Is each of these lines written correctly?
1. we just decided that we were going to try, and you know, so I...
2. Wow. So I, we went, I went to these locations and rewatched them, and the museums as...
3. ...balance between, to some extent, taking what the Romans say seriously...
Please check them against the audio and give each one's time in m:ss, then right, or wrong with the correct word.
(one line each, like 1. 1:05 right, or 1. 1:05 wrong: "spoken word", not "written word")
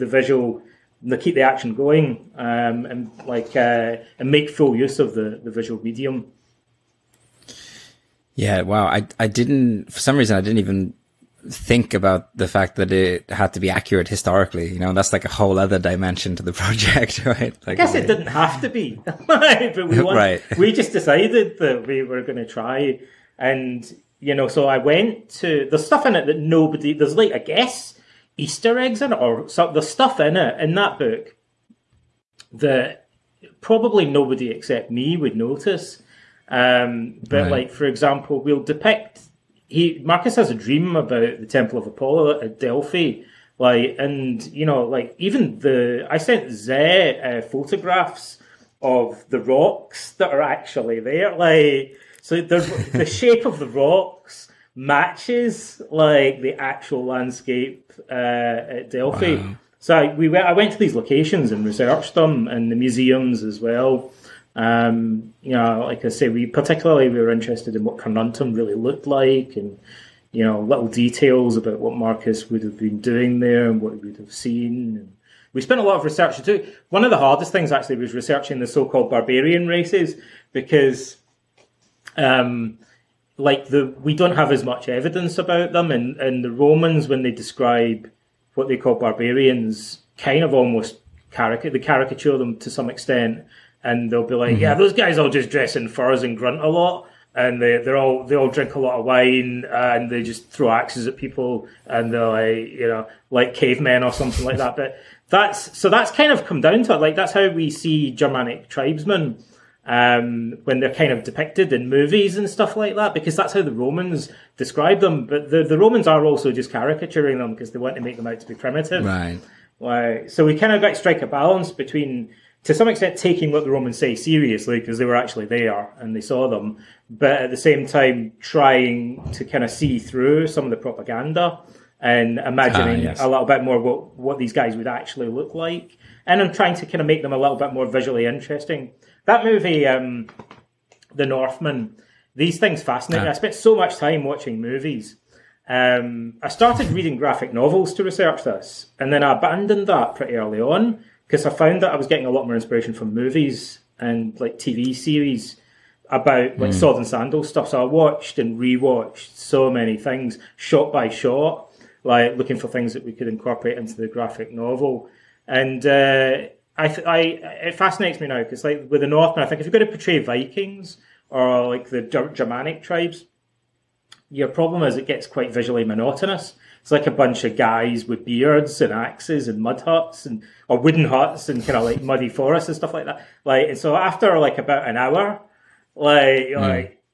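1. 0:20 right
2. 0:59 wrong: "researched", not "rewatched"
3. 2:01 right.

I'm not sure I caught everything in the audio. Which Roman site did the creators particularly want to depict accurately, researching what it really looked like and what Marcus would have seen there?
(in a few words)
Carnuntum.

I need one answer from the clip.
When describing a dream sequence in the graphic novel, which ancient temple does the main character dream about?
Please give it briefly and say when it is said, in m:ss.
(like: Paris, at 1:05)
Temple of Apollo at Delphi, at 0:41.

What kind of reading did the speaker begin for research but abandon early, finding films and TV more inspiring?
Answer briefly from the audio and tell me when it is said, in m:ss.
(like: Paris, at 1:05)
graphic novels, at 2:27.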